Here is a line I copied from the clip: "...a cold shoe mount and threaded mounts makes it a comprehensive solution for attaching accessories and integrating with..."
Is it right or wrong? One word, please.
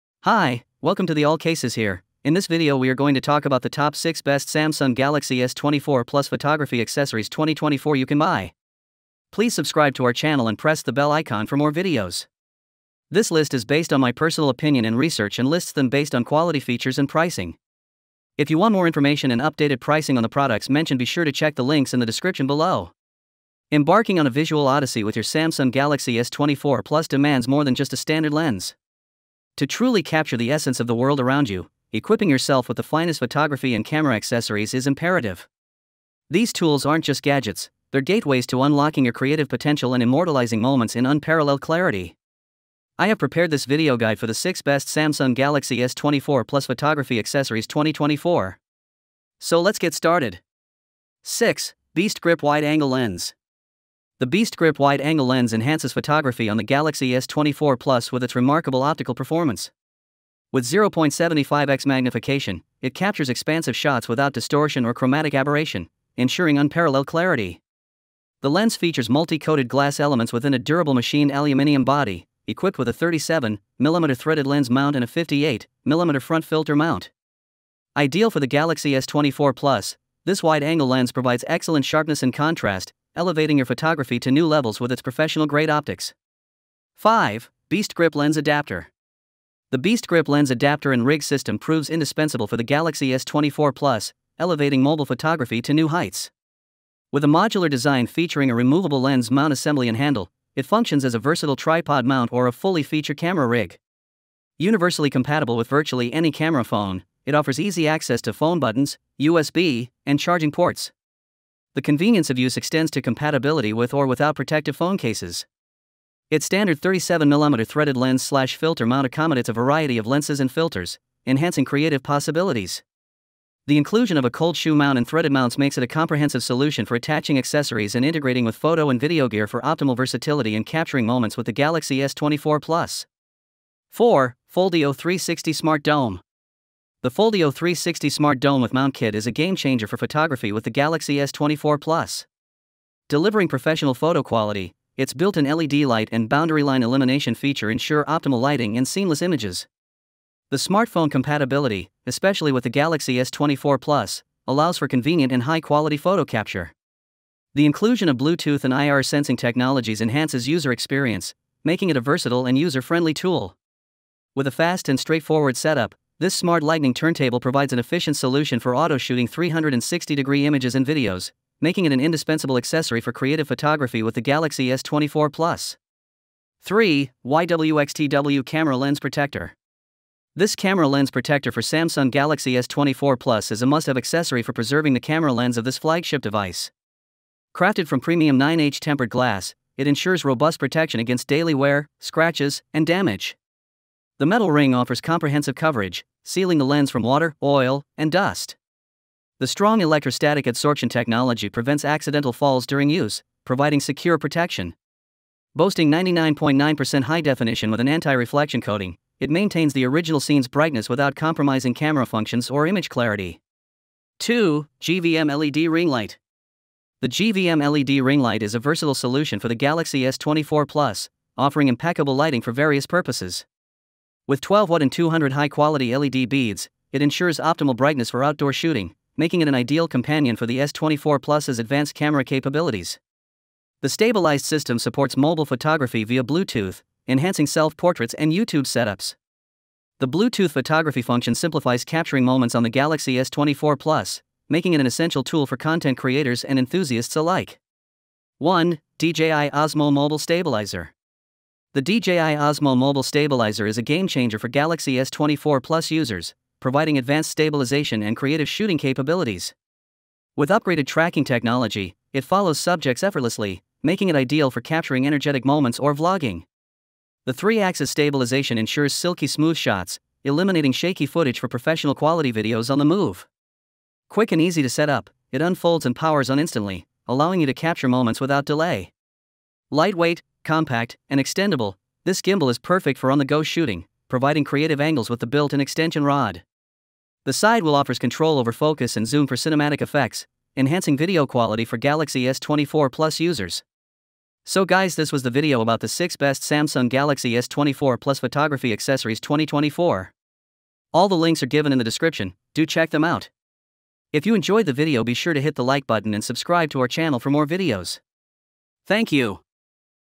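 right.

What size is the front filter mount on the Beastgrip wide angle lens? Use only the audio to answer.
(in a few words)
58mm.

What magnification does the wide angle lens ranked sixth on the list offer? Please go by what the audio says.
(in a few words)
0.75x.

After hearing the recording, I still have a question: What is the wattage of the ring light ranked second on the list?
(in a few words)
12 watt.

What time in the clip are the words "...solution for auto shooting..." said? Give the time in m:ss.
2:48.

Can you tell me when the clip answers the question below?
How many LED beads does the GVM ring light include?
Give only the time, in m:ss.
3:44.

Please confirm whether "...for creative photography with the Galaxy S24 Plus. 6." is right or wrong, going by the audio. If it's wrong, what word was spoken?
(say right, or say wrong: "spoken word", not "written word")
wrong: "3", not "6".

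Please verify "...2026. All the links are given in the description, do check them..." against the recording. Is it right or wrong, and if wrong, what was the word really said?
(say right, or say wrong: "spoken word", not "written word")
wrong: "2024", not "2026".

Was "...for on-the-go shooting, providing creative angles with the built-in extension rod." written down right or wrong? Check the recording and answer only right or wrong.
right.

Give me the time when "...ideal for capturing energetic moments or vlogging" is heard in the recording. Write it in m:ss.
4:24.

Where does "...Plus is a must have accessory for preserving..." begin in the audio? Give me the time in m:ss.
3:03.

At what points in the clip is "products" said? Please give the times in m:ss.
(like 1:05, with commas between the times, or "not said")
0:20.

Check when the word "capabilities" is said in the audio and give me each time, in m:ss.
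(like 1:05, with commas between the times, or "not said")
3:52, 4:18.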